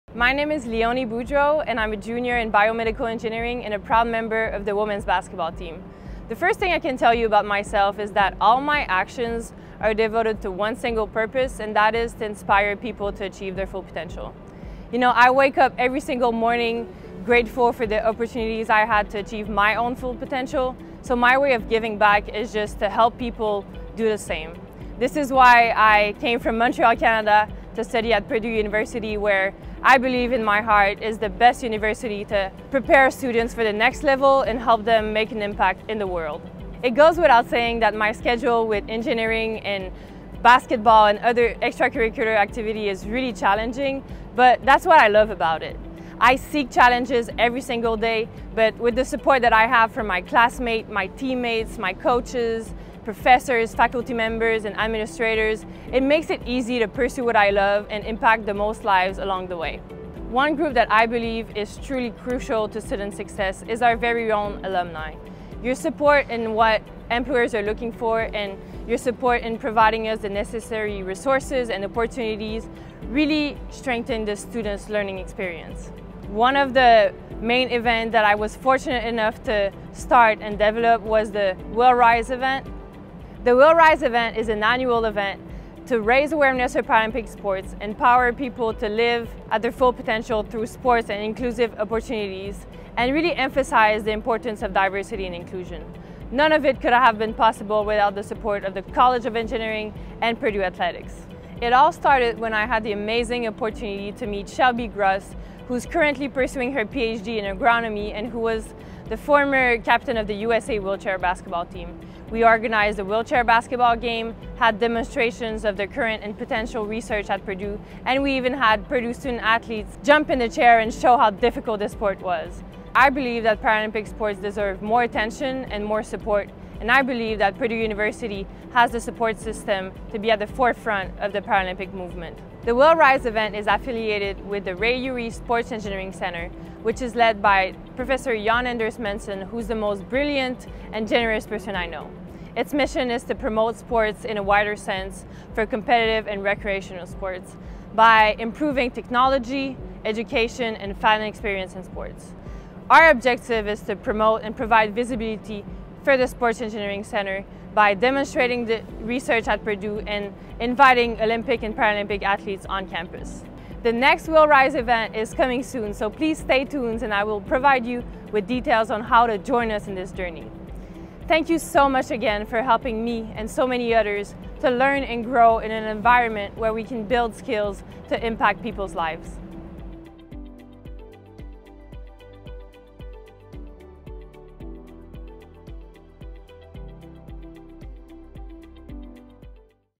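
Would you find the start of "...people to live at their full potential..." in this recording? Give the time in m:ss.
1:28.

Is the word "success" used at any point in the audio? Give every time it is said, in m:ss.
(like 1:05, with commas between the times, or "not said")
1:03.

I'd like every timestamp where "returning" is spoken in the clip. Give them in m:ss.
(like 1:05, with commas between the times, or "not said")
not said.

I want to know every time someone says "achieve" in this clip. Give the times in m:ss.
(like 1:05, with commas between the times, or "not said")
0:13, 0:19.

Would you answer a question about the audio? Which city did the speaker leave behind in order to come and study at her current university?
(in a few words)
Montreal.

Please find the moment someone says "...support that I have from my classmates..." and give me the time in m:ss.
0:49.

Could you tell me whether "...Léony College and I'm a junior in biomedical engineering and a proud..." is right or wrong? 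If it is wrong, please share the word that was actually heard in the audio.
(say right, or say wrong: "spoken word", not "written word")
wrong: "Boudreau", not "College".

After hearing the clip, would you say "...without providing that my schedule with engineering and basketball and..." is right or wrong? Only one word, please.
wrong.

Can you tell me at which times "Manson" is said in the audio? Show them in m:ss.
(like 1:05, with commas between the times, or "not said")
2:18.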